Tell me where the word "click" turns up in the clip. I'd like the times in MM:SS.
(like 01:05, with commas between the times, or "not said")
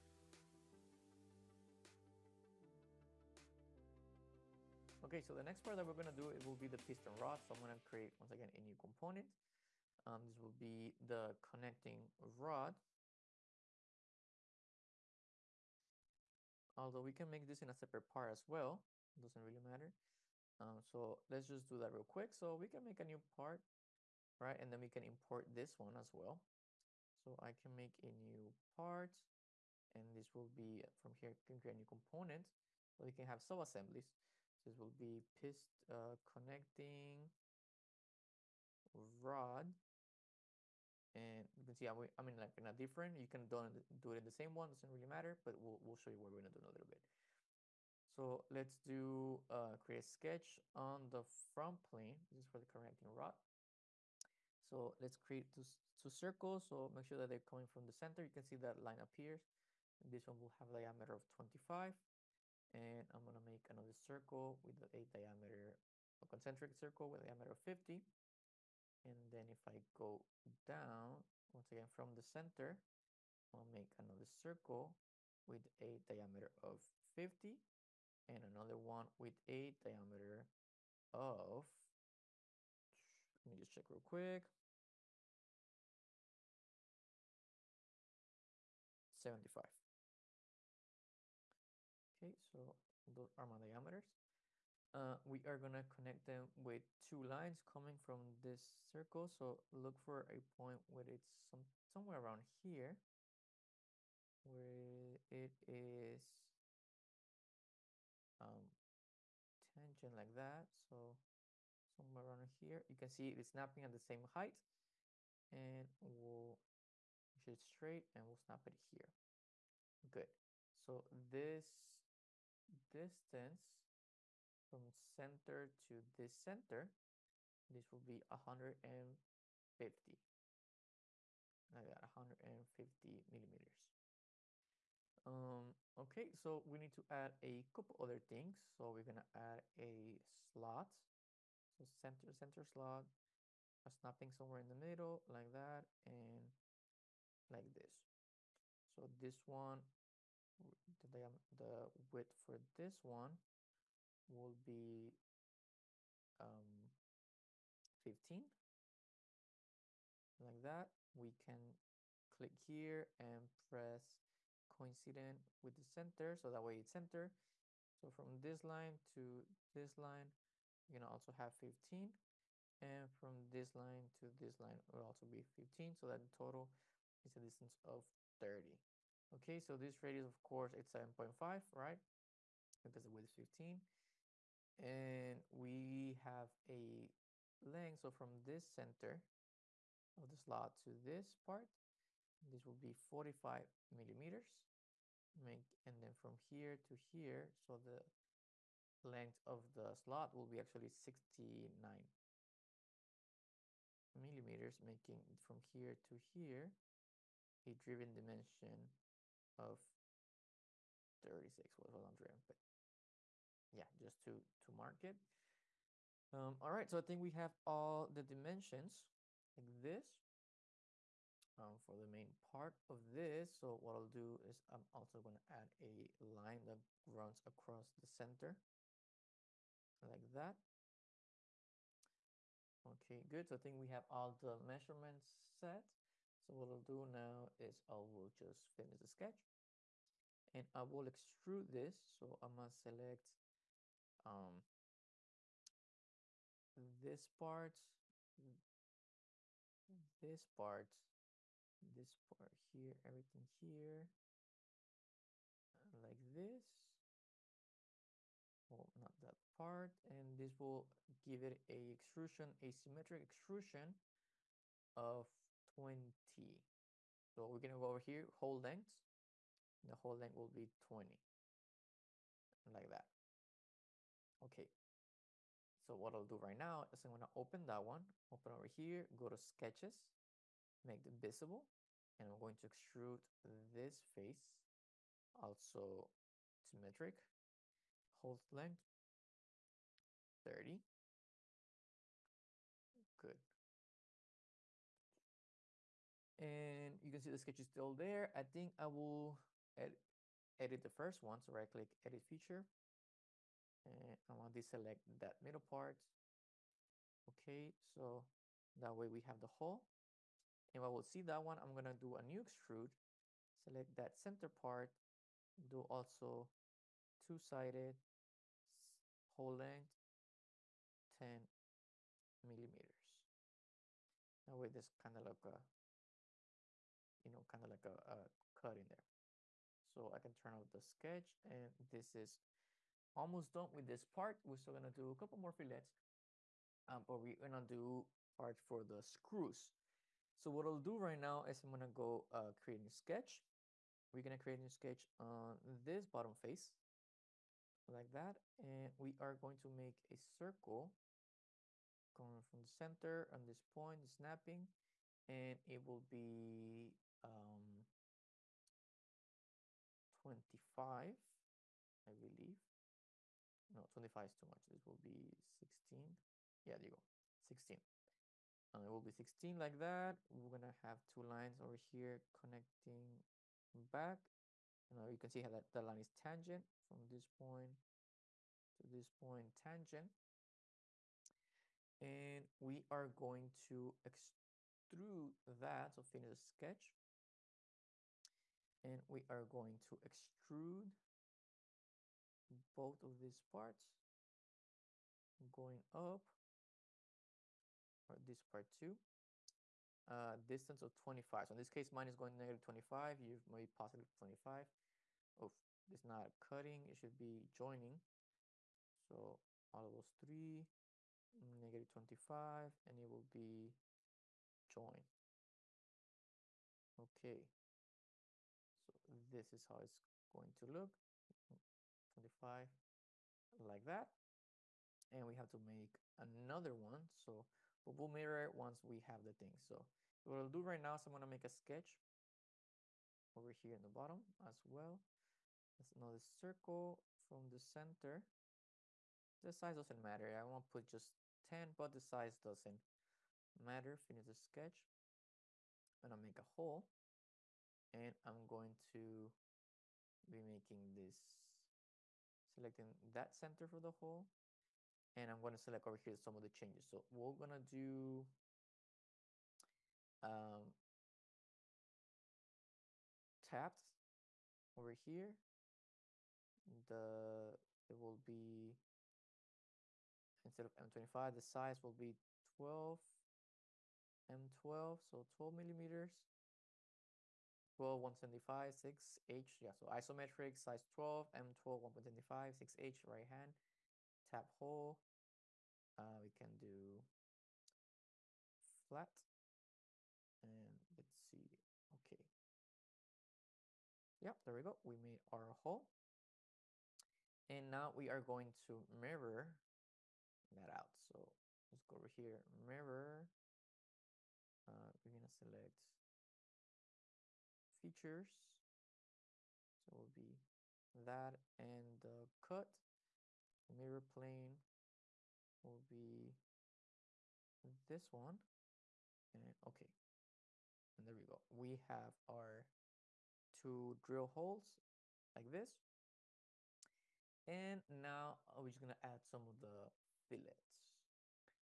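02:42, 05:01.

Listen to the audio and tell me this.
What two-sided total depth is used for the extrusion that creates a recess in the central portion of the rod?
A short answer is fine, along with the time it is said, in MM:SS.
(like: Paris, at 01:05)
10 millimeters, at 05:21.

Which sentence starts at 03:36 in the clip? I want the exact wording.
Um, all right, so I think we have all the dimensions like this um, for the main part of this.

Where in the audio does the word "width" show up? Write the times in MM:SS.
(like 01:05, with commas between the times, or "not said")
02:32, 03:03.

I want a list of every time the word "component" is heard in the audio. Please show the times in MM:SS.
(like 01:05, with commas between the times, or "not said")
00:08, 00:31.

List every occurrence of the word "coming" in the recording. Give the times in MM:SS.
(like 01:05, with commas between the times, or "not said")
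00:57, 01:37, 05:52.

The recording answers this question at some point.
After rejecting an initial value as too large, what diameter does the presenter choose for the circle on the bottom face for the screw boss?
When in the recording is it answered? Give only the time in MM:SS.
06:04.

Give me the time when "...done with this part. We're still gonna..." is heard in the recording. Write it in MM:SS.
05:33.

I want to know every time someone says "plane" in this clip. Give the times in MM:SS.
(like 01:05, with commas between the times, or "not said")
00:51, 08:34.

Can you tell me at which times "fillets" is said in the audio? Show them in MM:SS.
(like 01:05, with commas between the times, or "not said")
05:35, 08:50.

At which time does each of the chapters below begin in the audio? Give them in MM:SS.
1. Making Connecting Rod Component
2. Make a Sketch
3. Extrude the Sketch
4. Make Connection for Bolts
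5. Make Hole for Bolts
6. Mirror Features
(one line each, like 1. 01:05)
1. 00:31
2. 00:48
3. 03:59
4. 05:37
5. 07:09
6. 08:19.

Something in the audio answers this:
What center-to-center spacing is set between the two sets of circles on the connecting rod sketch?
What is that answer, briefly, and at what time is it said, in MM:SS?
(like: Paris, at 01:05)
150, at 02:07.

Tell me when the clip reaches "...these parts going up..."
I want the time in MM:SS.
06:33.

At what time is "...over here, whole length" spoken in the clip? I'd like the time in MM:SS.
04:27.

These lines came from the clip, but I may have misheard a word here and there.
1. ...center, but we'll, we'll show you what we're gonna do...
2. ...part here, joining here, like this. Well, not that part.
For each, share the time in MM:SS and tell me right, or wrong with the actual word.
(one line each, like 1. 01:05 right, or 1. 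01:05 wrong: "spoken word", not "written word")
1. 00:45 wrong: "matter", not "center"
2. 04:12 wrong: "everything", not "joining".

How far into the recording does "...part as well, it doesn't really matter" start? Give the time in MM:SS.
00:18.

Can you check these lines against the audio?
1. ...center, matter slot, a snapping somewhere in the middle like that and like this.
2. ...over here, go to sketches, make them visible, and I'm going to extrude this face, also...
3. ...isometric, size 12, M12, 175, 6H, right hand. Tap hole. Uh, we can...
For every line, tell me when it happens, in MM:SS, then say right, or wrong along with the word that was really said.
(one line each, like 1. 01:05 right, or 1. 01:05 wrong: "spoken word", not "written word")
1. 02:21 wrong: "center", not "matter"
2. 04:38 right
3. 07:59 right.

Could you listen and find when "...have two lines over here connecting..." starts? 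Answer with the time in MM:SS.
06:10.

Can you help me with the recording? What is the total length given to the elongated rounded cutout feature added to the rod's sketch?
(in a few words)
69 millimeters.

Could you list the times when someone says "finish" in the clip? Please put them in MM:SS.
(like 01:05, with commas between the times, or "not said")
03:58, 06:26, 07:23.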